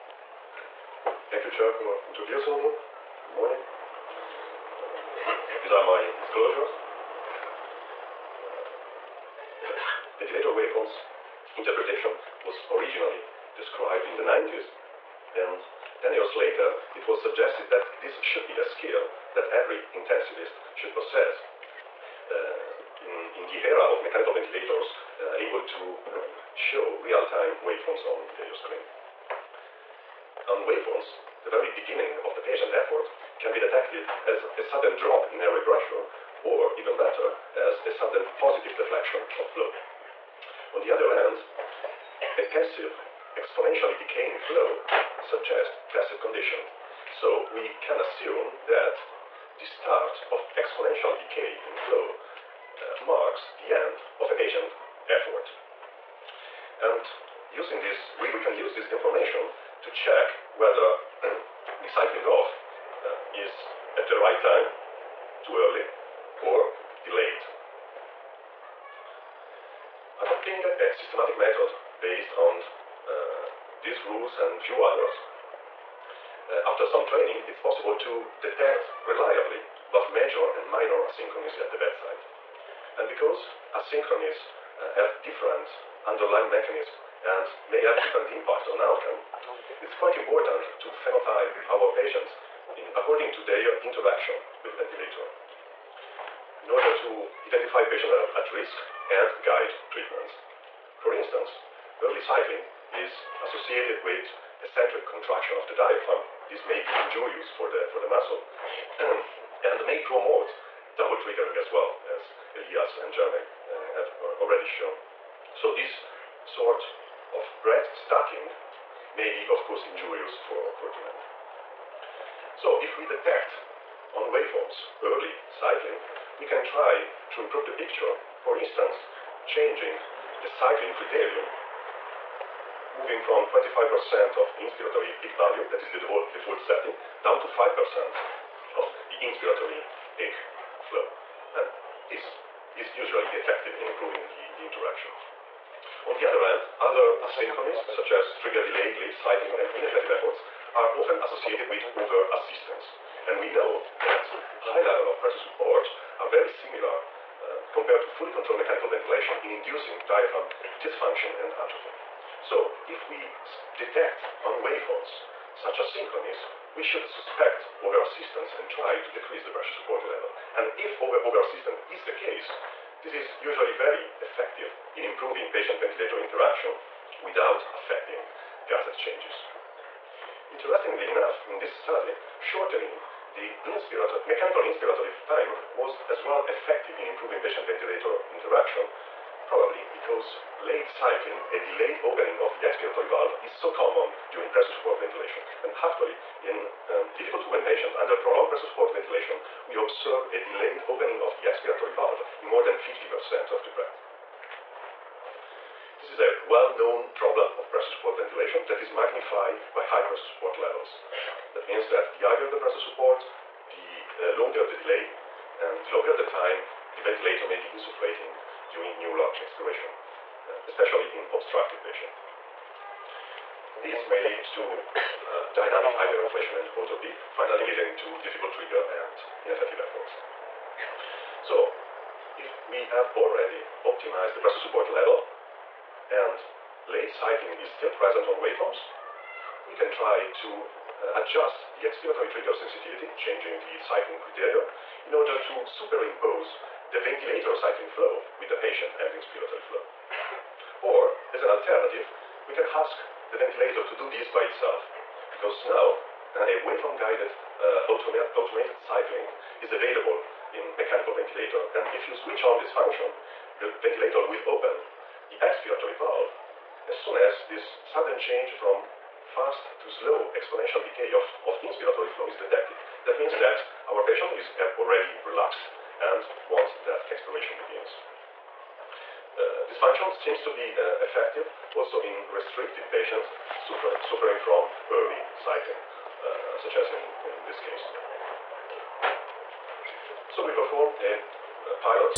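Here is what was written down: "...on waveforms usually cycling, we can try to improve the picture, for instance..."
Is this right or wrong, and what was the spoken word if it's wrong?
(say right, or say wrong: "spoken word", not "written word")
wrong: "early", not "usually".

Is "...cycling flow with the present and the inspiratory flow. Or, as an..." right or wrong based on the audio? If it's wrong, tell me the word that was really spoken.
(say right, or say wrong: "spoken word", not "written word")
wrong: "patient", not "present".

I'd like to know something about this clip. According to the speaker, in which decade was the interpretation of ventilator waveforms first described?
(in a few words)
1990s.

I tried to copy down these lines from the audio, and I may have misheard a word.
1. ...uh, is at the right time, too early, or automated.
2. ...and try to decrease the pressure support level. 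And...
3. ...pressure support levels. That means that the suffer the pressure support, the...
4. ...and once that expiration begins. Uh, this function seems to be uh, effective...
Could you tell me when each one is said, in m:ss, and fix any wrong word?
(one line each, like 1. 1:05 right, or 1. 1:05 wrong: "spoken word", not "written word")
1. 1:03 wrong: "delayed", not "automated"
2. 2:48 right
3. 3:30 wrong: "higher", not "suffer"
4. 4:35 right.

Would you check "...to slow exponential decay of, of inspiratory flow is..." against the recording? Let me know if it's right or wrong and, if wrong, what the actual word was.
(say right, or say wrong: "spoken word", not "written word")
right.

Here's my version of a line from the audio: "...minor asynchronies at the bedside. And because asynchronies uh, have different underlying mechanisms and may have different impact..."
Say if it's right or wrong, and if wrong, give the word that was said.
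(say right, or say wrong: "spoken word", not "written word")
right.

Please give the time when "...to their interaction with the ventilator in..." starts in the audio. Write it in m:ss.
1:33.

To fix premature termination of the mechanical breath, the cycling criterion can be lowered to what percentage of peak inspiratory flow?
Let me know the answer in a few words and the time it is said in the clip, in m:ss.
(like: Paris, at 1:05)
5%, at 2:17.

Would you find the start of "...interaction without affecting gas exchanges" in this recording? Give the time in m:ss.
2:56.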